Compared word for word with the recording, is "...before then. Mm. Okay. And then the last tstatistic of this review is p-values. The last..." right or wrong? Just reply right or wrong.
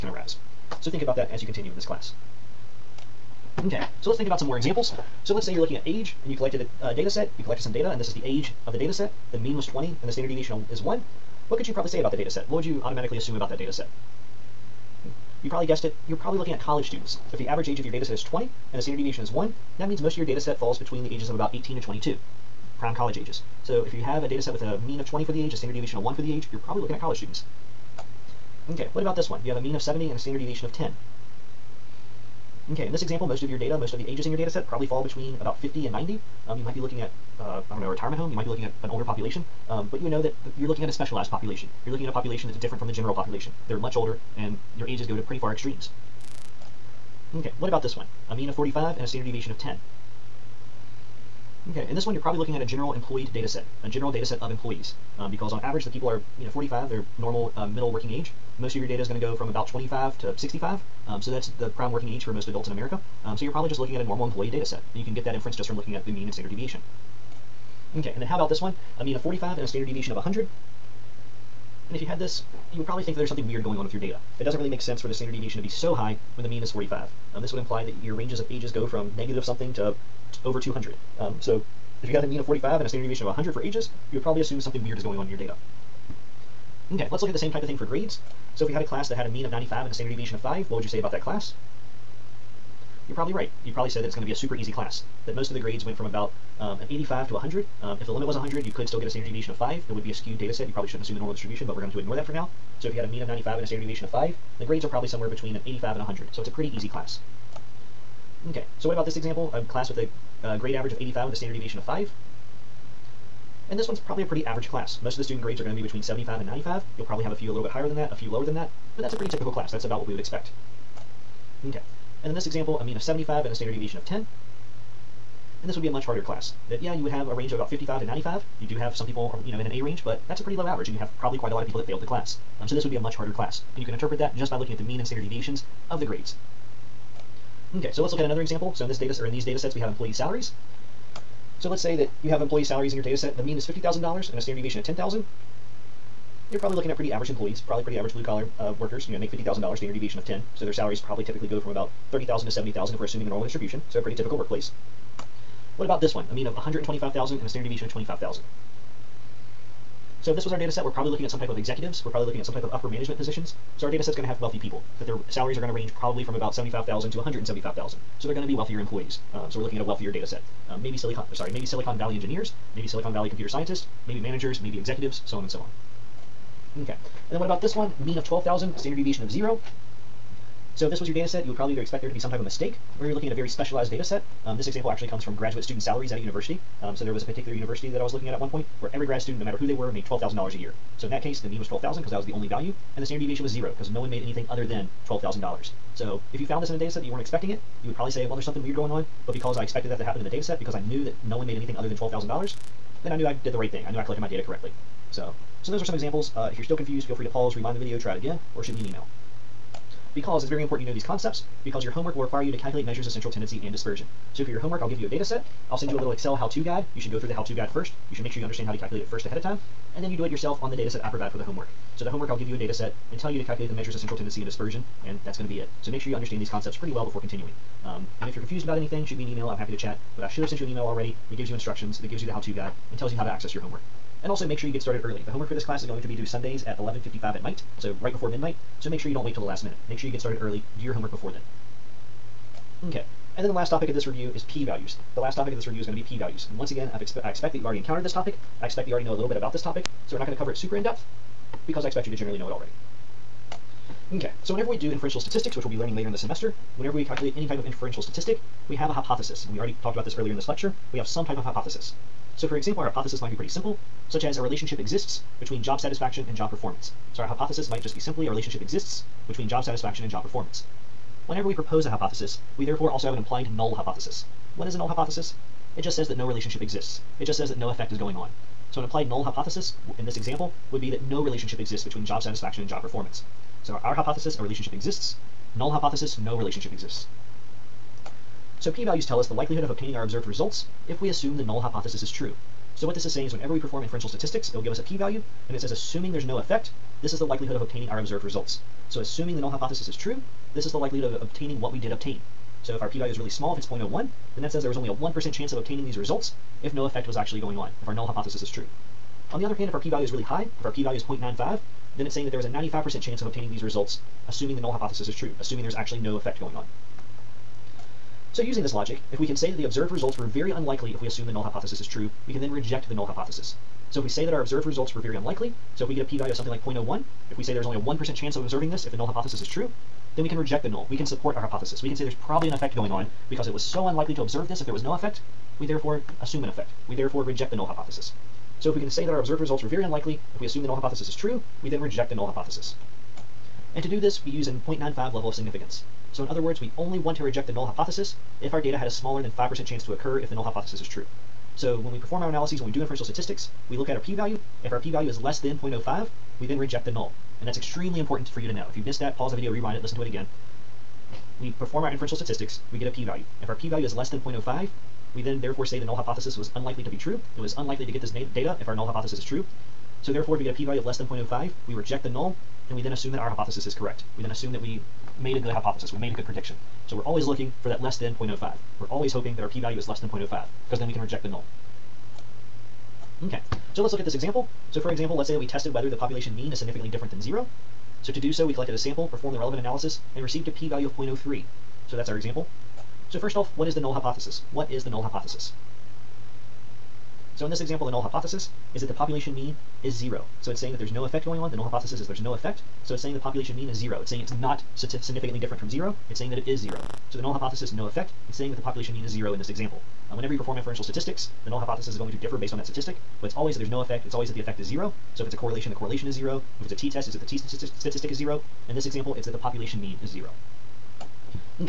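wrong.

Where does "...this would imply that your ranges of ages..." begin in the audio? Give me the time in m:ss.
1:17.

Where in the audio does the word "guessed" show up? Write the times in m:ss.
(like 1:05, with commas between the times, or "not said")
0:15.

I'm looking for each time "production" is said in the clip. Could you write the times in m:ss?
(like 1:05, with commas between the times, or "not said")
not said.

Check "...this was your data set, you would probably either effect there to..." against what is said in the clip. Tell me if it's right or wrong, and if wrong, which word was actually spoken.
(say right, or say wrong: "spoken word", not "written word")
wrong: "expect", not "effect".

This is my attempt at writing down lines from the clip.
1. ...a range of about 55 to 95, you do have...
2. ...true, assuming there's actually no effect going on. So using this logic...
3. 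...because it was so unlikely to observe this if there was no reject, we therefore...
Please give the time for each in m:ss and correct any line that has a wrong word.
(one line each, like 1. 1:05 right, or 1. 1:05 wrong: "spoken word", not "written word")
1. 2:07 right
2. 5:15 right
3. 5:33 wrong: "effect", not "reject".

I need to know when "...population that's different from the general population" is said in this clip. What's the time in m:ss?
0:42.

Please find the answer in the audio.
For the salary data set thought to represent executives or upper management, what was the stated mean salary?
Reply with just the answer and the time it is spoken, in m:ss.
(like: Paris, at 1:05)
$125,000, at 2:36.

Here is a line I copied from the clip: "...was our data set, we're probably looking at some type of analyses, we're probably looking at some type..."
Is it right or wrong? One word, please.
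wrong.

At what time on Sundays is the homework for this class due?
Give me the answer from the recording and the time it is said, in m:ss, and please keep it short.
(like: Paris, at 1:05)
11:55 pm, at 3:56.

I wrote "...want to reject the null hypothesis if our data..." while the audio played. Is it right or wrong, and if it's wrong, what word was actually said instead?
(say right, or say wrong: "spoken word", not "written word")
right.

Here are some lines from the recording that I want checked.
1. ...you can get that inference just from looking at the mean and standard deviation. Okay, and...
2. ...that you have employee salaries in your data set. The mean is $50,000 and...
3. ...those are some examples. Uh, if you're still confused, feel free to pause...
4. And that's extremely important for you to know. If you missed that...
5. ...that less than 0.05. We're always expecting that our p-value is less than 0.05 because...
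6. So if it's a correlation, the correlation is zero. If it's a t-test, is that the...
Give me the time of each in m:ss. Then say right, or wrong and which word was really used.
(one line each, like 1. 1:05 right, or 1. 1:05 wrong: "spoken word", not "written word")
1. 1:04 right
2. 2:21 right
3. 3:25 right
4. 5:57 right
5. 6:17 wrong: "hoping", not "expecting"
6. 6:55 right.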